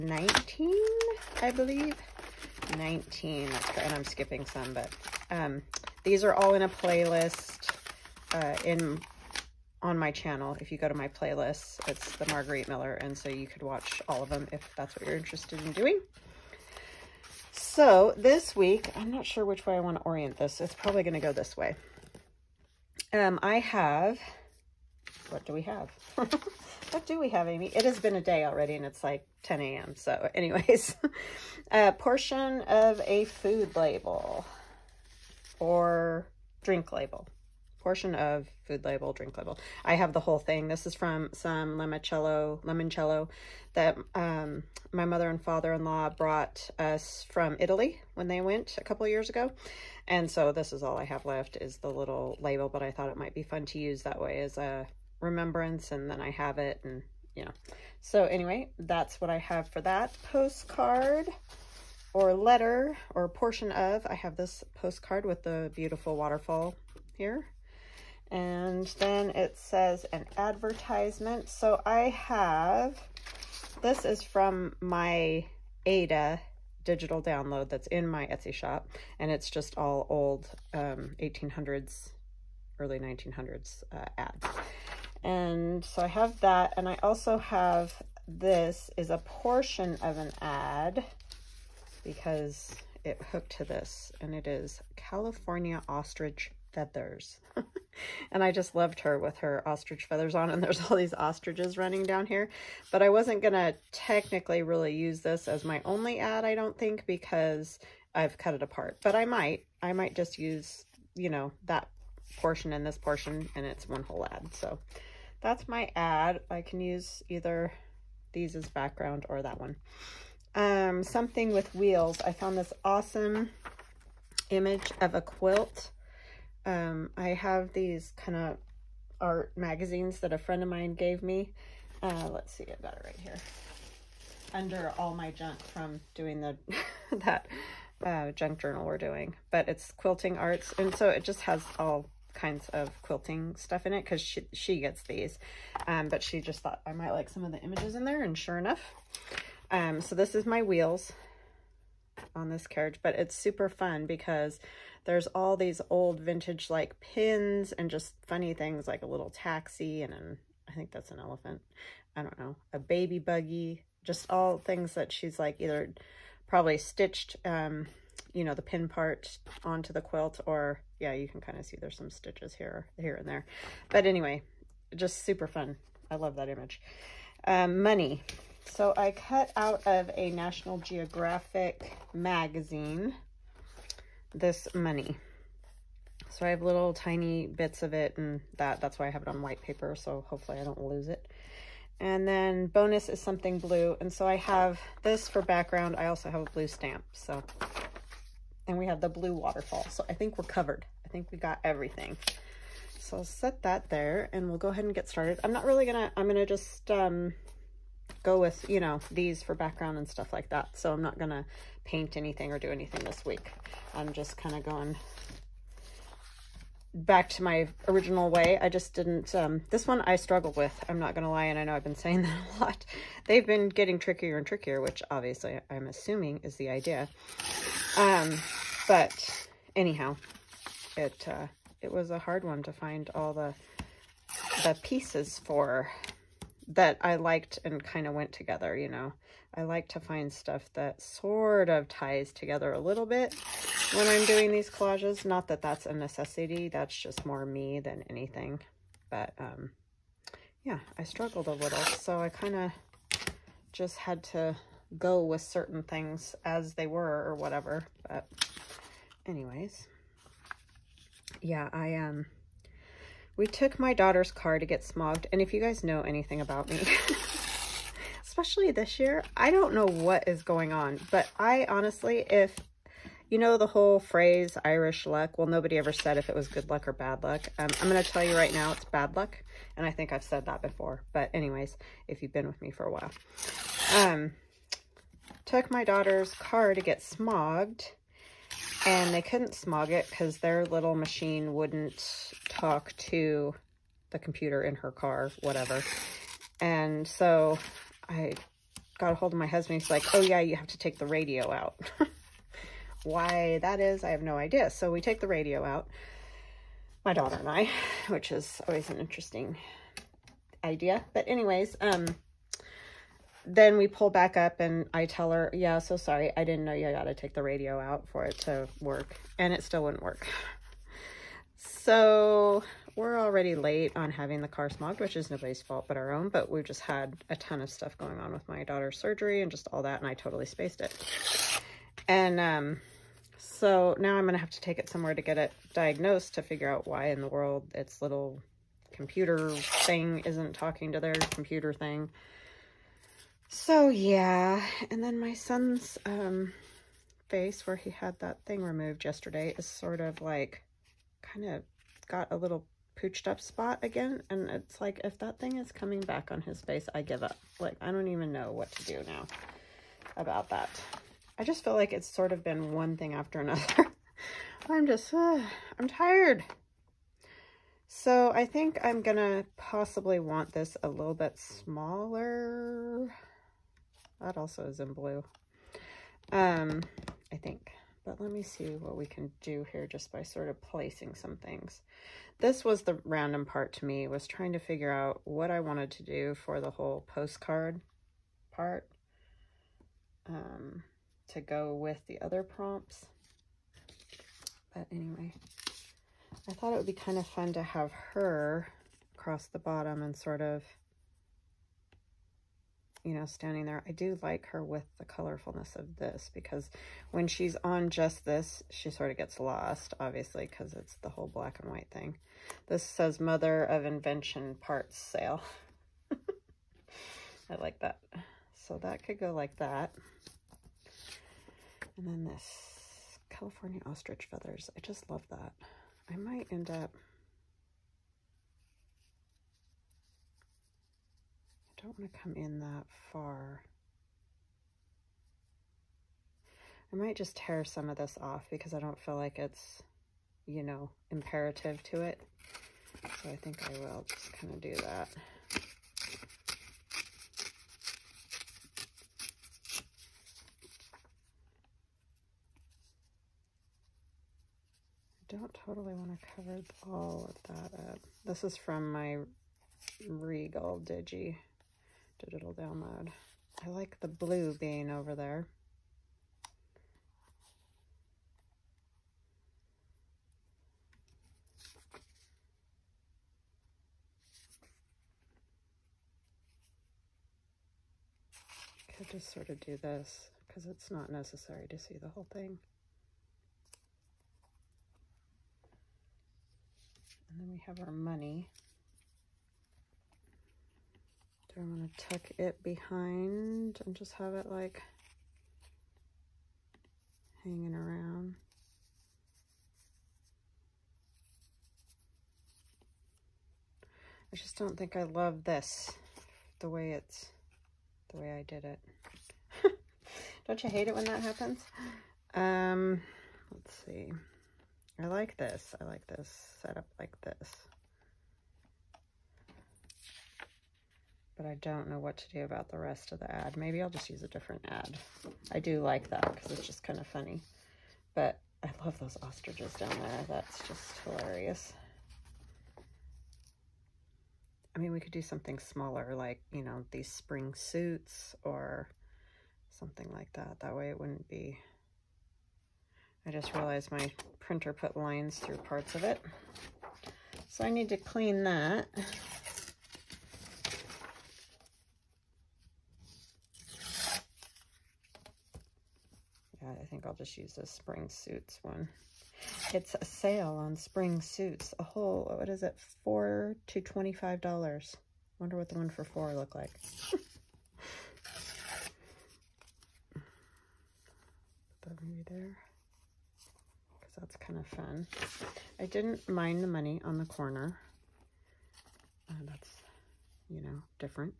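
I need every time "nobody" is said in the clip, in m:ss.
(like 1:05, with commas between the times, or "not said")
4:35, 5:25.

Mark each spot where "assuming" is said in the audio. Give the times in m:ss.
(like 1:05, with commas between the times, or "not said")
3:45.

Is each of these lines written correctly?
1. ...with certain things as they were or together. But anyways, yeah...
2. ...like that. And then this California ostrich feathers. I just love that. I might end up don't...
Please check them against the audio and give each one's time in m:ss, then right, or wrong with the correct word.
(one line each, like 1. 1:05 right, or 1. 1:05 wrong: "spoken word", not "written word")
1. 4:15 wrong: "whatever", not "together"
2. 6:59 right.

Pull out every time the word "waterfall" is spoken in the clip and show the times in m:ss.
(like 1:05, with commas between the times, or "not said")
1:06, 3:19.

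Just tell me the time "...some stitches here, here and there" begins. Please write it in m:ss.
2:51.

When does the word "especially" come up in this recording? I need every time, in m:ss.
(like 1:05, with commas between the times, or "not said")
4:28.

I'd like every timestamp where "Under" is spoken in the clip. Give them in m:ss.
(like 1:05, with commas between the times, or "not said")
2:14.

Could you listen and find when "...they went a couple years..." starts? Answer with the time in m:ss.
0:48.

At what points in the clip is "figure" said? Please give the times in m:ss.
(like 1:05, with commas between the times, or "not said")
5:36, 6:24.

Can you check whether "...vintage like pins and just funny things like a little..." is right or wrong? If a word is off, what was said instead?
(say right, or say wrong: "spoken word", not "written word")
right.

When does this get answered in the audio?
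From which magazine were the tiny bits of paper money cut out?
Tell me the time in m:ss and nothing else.
3:00.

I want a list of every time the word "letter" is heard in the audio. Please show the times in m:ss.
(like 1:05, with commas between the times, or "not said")
1:02.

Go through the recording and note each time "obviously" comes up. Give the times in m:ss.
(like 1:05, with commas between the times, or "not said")
3:45, 6:49.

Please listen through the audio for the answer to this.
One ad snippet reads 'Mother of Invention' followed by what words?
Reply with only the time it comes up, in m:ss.
6:54.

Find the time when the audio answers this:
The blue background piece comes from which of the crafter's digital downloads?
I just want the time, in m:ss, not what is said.
7:40.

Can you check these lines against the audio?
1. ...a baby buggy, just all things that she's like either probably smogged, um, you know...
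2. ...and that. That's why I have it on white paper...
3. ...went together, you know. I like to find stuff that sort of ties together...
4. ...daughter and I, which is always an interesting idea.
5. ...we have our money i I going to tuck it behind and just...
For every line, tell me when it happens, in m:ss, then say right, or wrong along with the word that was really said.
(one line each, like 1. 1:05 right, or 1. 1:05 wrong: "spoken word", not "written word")
1. 2:42 wrong: "stitched", not "smogged"
2. 3:08 right
3. 3:58 right
4. 5:07 right
5. 8:07 right.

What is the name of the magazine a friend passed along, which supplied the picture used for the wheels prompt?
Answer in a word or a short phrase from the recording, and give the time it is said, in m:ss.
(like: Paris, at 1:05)
Quilting Arts, at 2:19.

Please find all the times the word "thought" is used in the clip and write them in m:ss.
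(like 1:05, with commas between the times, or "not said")
0:52, 2:26, 6:36.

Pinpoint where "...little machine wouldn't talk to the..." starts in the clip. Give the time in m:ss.
4:50.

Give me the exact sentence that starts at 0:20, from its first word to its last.
It's probably going to go this way.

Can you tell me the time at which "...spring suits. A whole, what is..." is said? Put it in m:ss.
9:20.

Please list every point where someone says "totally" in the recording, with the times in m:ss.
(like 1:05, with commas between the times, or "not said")
5:30, 7:35.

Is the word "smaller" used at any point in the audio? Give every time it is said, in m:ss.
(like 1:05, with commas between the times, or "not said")
6:11, 8:55.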